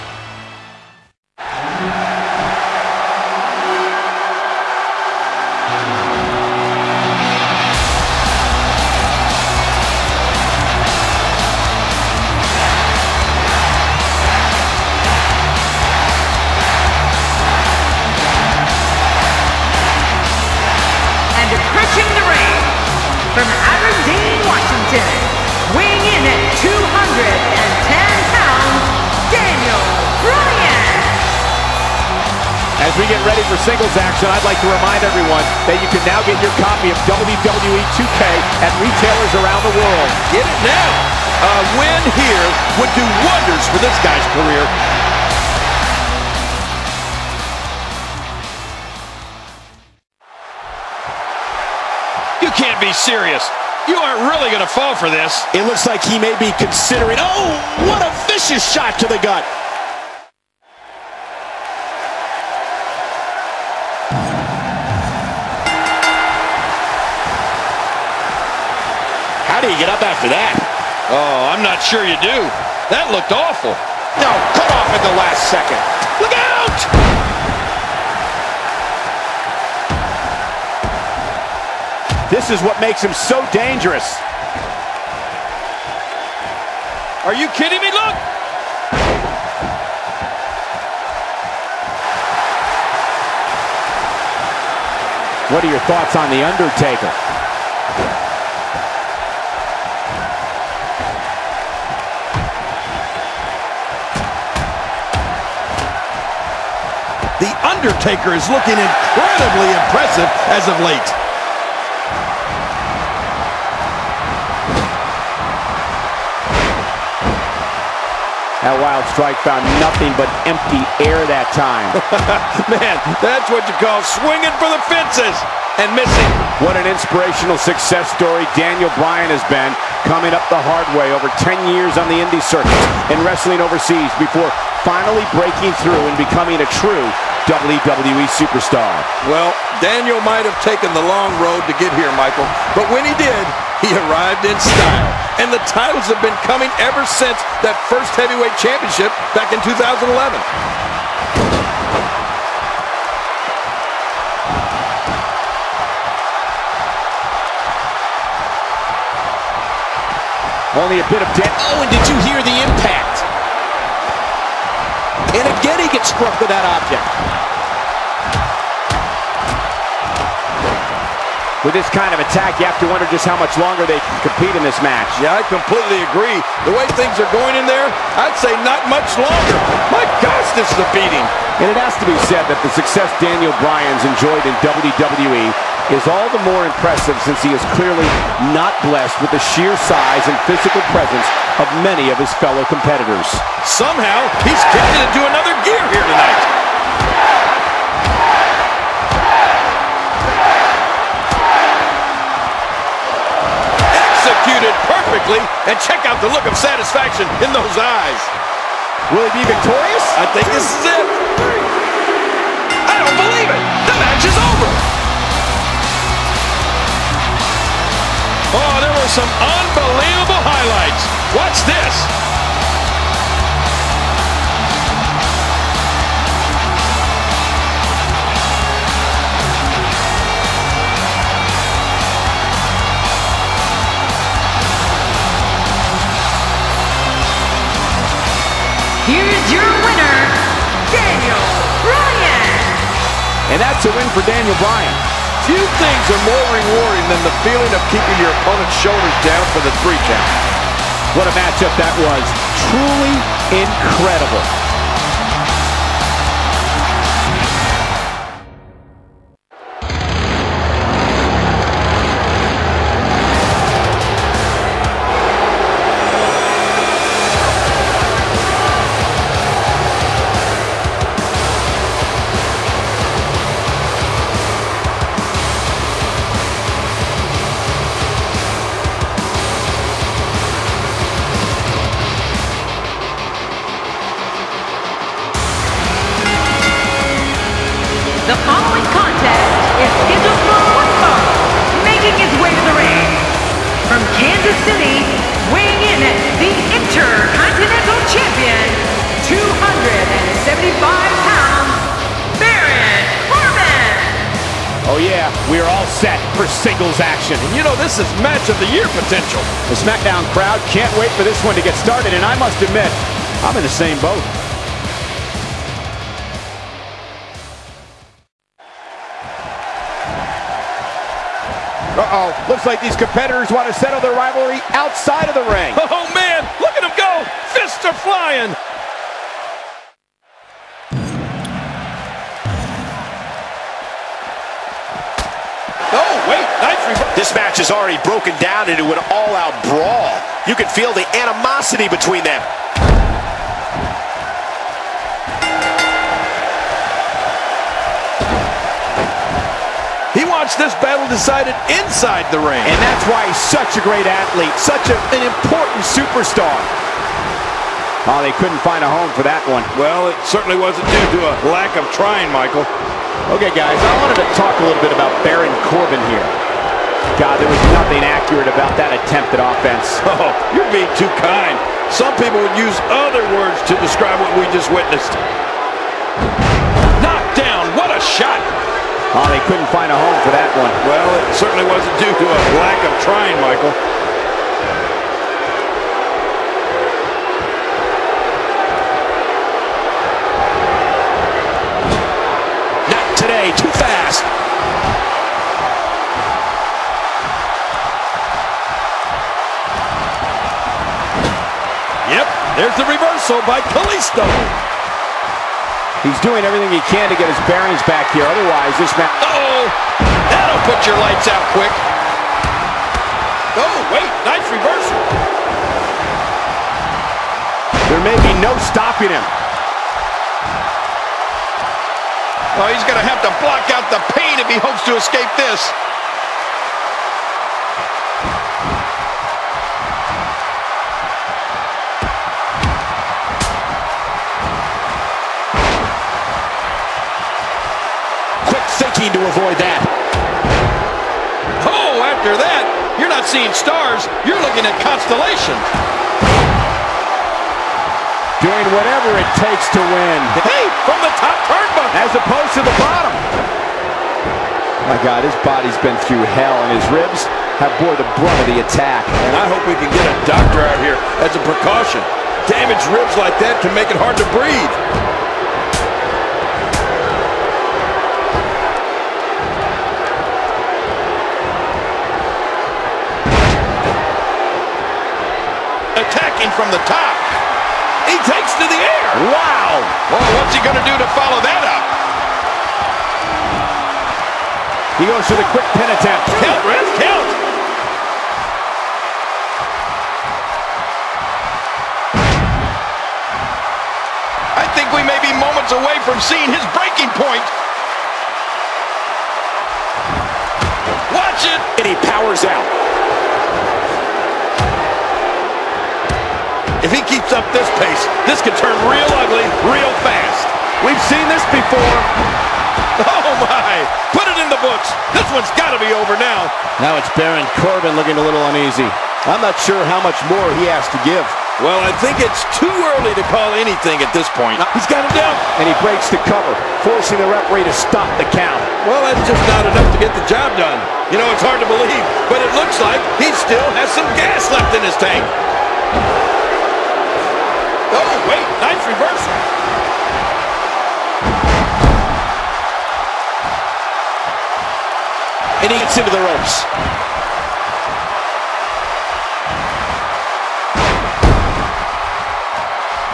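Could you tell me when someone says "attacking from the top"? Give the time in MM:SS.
07:56.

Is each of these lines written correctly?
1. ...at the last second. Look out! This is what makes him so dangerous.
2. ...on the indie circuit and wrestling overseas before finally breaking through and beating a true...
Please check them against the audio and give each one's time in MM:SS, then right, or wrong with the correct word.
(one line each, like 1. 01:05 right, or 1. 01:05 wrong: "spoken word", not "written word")
1. 01:14 right
2. 02:11 wrong: "becoming", not "beating".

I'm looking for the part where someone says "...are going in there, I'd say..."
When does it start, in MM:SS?
02:57.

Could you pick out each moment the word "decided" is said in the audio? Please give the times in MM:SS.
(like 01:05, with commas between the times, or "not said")
05:51.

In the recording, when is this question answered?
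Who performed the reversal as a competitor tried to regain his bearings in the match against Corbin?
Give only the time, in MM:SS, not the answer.
06:43.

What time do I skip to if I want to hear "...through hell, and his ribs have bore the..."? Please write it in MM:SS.
07:36.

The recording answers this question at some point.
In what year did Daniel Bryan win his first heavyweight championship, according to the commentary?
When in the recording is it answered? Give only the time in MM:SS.
02:29.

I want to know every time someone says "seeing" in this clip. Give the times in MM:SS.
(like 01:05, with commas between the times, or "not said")
07:23, 08:16.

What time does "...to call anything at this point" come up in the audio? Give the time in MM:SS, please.
08:43.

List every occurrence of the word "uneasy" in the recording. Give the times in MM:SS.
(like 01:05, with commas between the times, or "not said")
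08:38.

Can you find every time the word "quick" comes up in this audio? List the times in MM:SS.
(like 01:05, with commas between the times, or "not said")
06:51, 08:05.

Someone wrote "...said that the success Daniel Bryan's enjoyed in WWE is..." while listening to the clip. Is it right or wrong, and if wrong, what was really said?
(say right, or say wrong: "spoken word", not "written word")
right.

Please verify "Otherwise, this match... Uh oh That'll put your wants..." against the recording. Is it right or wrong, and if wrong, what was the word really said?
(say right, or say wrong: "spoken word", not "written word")
wrong: "lights", not "wants".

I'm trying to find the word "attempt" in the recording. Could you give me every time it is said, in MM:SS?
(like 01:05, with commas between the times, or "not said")
06:08, 08:05.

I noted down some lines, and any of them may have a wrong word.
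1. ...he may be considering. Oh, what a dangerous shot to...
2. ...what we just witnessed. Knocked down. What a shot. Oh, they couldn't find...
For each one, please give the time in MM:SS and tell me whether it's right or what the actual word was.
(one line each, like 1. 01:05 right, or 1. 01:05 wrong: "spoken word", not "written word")
1. 00:56 wrong: "vicious", not "dangerous"
2. 06:14 right.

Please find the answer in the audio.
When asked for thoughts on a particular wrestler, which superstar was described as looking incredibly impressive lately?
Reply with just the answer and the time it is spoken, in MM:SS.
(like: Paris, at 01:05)
The Undertaker, at 01:36.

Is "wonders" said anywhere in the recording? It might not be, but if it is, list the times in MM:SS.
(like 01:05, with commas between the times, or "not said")
00:43, 02:52.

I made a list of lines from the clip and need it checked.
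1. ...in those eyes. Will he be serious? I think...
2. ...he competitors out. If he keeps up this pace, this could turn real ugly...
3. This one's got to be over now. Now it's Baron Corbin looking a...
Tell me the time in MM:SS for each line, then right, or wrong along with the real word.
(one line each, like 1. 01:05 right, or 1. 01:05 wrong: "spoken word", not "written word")
1. 03:27 wrong: "victorious", not "serious"
2. 08:21 wrong: "powers", not "competitors"
3. 08:35 right.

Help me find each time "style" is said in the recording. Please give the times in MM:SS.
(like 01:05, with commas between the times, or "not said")
02:24.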